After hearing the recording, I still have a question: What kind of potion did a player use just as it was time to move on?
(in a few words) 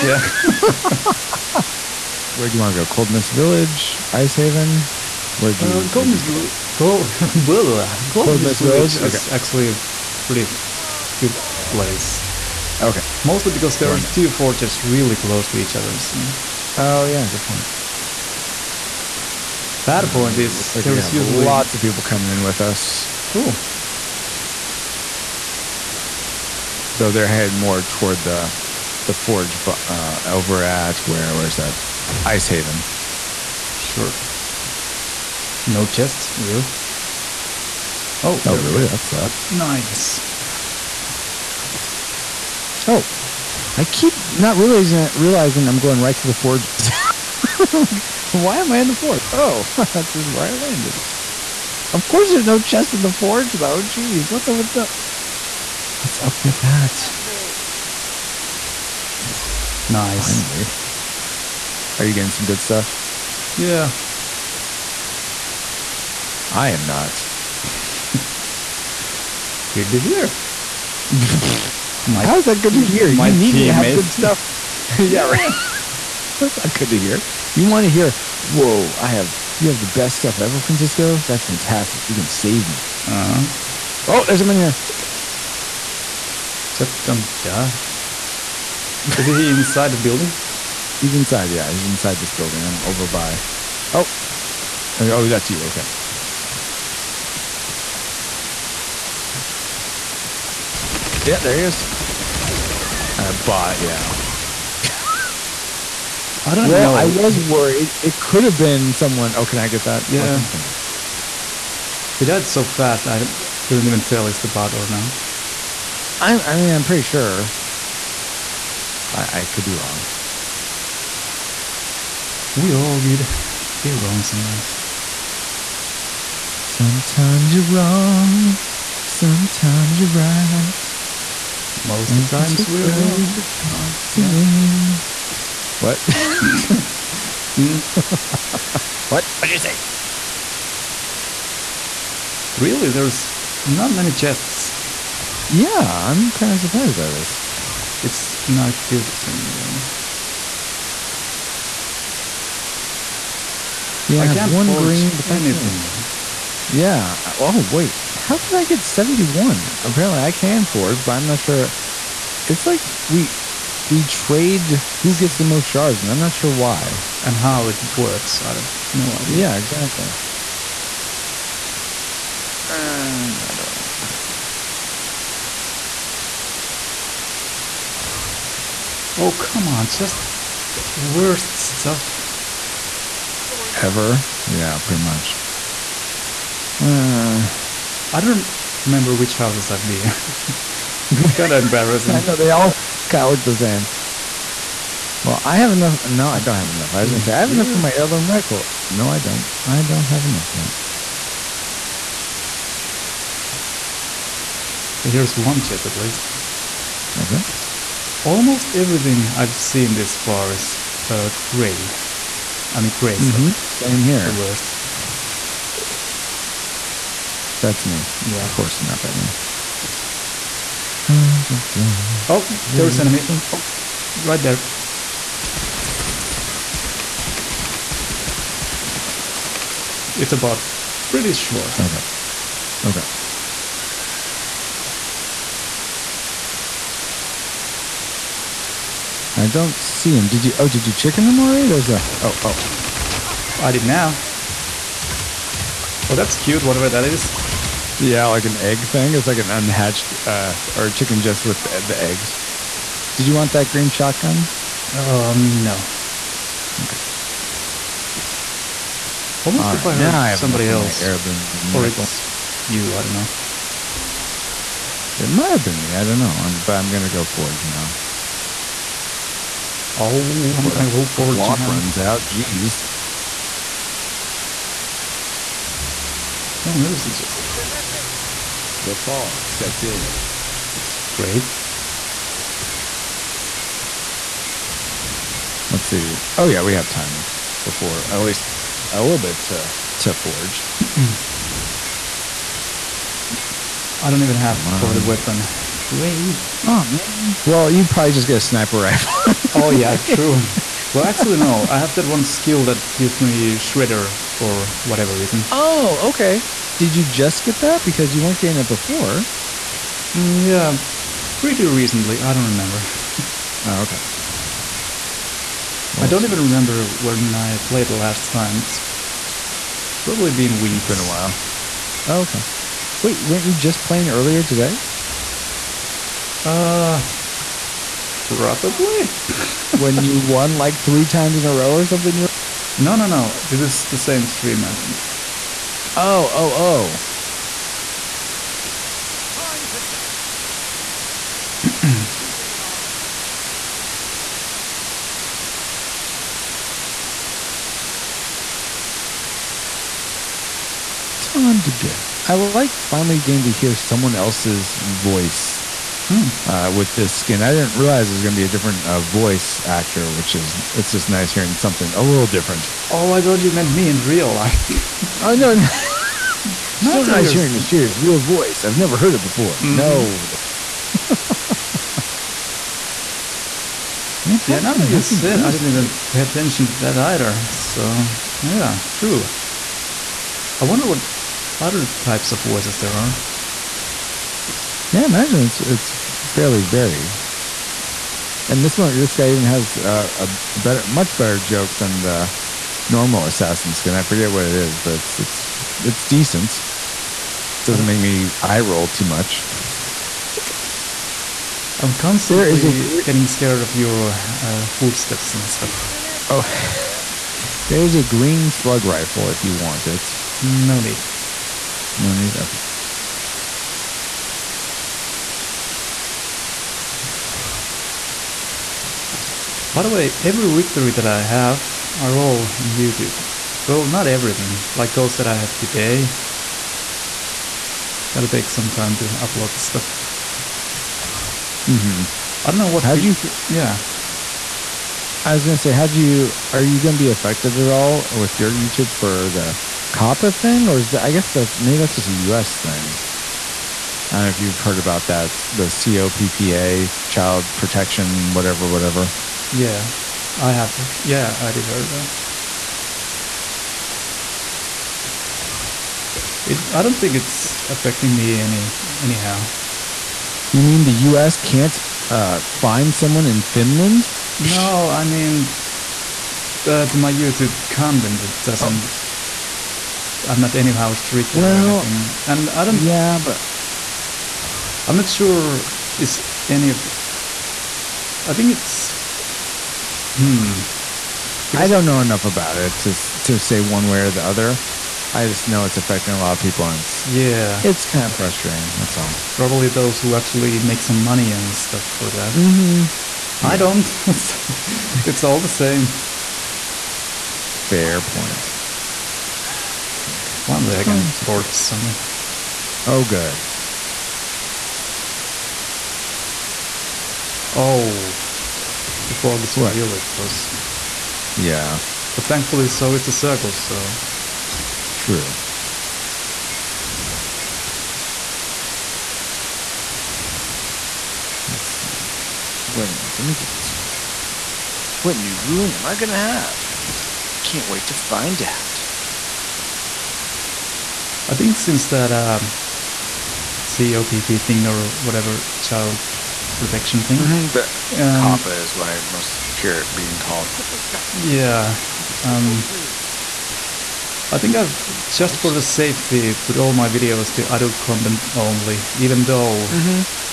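armor potion.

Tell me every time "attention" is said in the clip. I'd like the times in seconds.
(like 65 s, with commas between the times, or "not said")
376 s.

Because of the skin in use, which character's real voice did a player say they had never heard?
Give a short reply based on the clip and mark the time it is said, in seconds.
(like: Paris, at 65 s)
Mistheria, at 367 s.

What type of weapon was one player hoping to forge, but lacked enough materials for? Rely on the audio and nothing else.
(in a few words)
heirloom rifle.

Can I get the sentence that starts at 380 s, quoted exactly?
I wonder what other types of voices there are.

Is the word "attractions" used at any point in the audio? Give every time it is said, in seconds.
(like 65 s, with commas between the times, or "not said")
not said.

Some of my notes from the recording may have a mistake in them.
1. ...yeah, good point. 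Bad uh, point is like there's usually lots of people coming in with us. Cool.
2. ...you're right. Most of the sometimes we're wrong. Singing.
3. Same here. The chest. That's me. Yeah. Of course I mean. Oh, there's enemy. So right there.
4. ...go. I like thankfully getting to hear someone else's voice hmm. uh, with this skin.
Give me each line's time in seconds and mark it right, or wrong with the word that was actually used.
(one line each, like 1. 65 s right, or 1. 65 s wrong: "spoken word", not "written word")
1. 17 s right
2. 129 s wrong: "times", not "sometimes"
3. 213 s wrong: "worst", not "chest"
4. 351 s wrong: "finally", not "thankfully".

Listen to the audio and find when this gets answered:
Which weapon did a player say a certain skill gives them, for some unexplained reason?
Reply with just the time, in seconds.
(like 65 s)
303 s.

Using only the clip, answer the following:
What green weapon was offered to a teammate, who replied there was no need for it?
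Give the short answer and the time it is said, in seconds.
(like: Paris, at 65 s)
slug rifle, at 408 s.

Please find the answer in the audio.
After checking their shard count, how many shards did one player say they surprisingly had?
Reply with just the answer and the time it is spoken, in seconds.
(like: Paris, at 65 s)
71, at 158 s.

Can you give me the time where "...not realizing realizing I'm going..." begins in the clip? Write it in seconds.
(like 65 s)
44 s.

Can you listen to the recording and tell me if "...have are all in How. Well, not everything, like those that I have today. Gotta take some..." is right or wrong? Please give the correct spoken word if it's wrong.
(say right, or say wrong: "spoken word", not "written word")
wrong: "YouTube", not "How".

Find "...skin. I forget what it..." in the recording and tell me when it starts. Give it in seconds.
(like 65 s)
393 s.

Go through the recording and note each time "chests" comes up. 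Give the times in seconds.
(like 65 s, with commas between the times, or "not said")
35 s, 52 s, 144 s, 205 s.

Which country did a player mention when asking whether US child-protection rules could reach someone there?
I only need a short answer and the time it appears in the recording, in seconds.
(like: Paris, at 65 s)
Finland, at 463 s.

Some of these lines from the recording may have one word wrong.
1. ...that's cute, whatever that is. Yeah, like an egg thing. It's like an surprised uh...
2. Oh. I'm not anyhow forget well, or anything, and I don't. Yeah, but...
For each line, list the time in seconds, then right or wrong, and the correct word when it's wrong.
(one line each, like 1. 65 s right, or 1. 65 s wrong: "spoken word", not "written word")
1. 246 s wrong: "unhatched", not "surprised"
2. 470 s wrong: "street", not "forget".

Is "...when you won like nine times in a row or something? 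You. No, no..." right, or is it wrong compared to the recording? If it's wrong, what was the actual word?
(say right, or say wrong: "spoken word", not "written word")
wrong: "three", not "nine".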